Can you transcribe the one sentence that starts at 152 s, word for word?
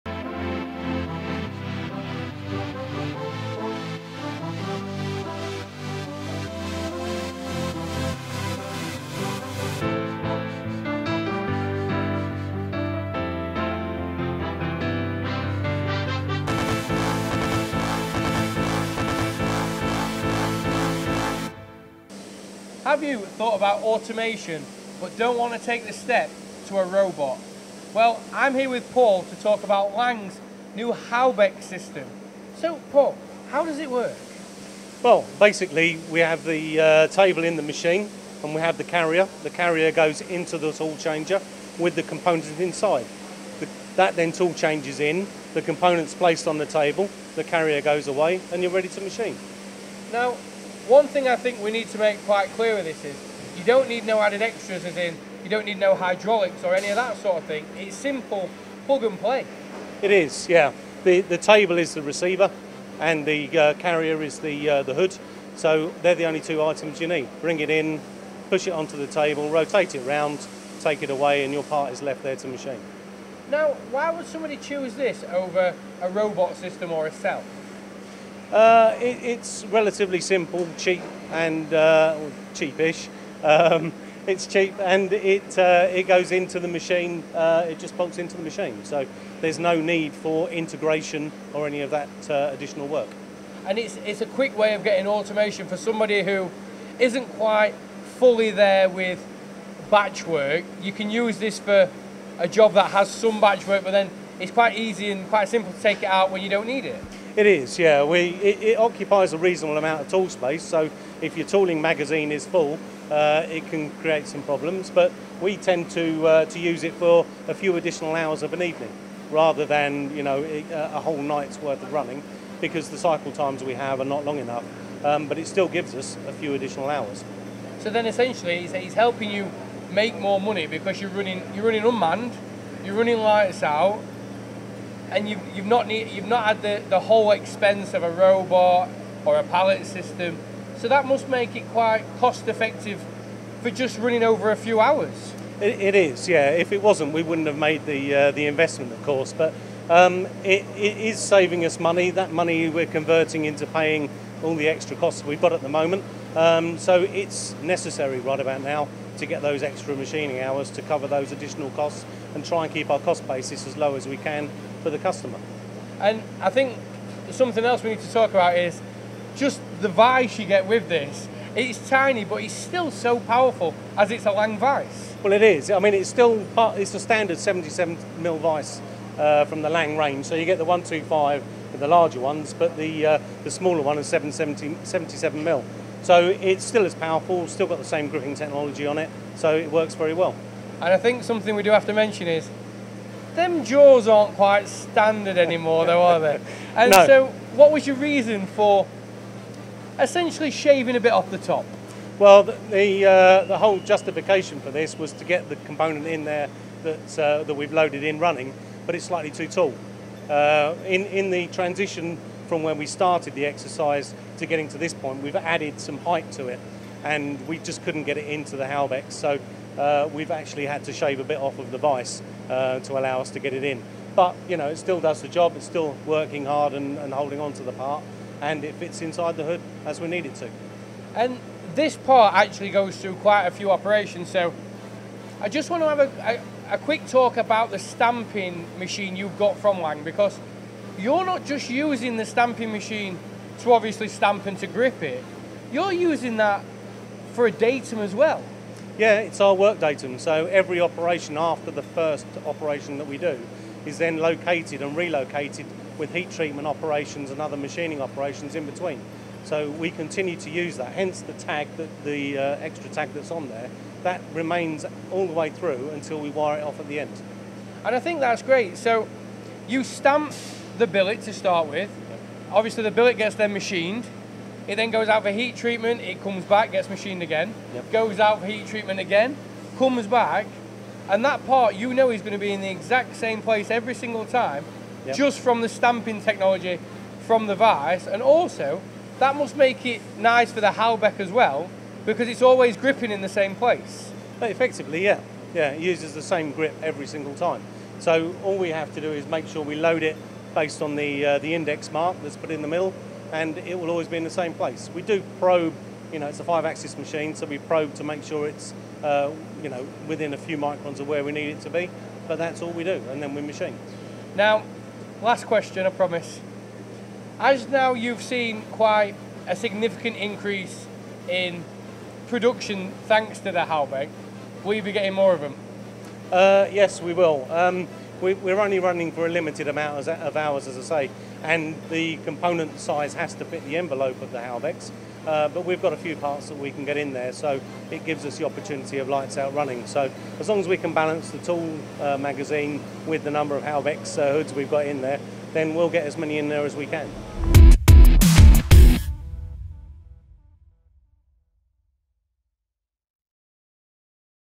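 That money we're converting into paying all the extra costs we've got at the moment.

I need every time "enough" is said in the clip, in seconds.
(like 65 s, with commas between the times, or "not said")
124 s.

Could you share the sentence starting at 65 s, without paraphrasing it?
So they're the only two items you need.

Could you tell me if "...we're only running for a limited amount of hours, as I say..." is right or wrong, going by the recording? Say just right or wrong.
right.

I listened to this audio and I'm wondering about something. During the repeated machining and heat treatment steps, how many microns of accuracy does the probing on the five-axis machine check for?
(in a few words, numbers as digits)
A few microns.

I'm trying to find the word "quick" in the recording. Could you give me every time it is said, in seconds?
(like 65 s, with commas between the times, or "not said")
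94 s, 236 s.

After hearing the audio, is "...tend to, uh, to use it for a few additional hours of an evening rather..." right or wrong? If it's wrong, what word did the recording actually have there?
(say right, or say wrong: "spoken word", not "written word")
right.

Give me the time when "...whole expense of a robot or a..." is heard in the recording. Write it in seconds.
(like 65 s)
137 s.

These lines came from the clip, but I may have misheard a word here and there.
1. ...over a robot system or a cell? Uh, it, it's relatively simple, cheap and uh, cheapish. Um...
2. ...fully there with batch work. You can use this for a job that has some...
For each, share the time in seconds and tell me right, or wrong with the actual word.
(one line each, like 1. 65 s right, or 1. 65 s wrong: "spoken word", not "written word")
1. 75 s right
2. 98 s right.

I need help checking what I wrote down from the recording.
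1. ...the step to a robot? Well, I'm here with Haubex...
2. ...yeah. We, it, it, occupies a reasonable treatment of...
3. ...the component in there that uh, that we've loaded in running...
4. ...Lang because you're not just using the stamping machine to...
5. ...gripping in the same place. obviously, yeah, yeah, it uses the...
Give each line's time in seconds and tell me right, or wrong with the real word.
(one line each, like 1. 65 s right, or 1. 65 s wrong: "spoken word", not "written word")
1. 25 s wrong: "Paul", not "Haubex"
2. 107 s wrong: "amount", not "treatment"
3. 205 s right
4. 239 s right
5. 292 s wrong: "effectively", not "obviously".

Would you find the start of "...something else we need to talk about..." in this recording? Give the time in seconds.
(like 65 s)
167 s.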